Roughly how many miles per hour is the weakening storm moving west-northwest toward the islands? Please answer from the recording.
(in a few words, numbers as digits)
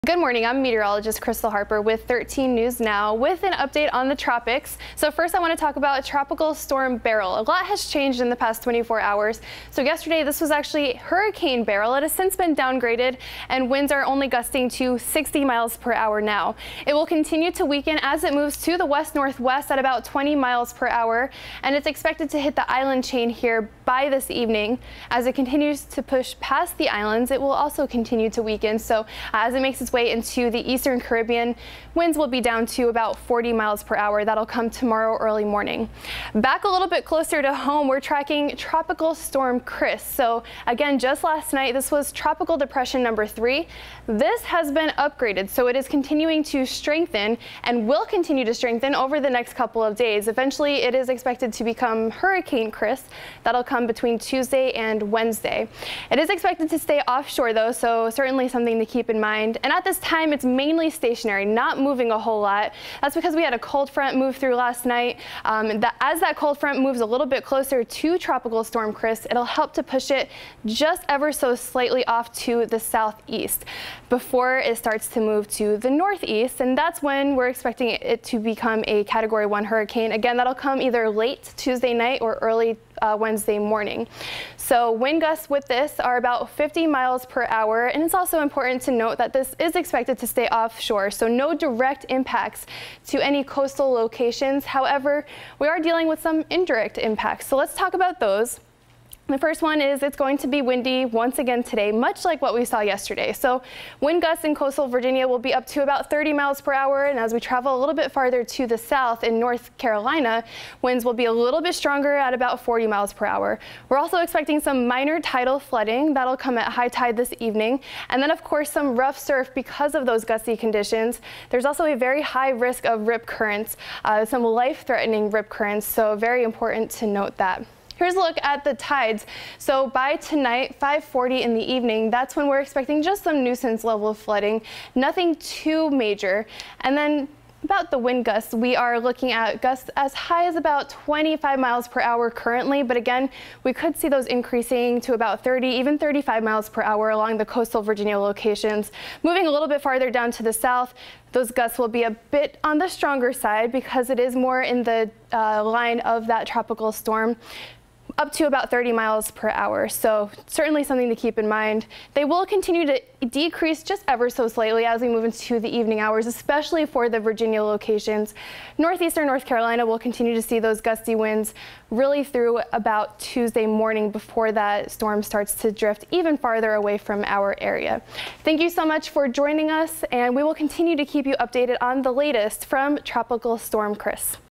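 20 miles per hour.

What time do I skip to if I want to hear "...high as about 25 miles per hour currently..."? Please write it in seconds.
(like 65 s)
140 s.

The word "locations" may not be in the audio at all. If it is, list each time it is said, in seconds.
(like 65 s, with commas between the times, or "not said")
93 s, 148 s, 167 s.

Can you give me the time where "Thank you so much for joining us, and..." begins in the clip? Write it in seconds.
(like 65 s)
178 s.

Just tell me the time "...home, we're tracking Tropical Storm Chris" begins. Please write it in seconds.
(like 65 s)
37 s.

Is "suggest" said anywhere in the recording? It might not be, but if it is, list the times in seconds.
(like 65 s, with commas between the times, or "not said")
not said.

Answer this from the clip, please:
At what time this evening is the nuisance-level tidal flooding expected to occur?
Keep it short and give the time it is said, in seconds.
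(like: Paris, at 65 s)
5:40, at 130 s.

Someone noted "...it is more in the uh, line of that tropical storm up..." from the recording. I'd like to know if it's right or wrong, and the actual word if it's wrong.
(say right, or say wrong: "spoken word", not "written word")
right.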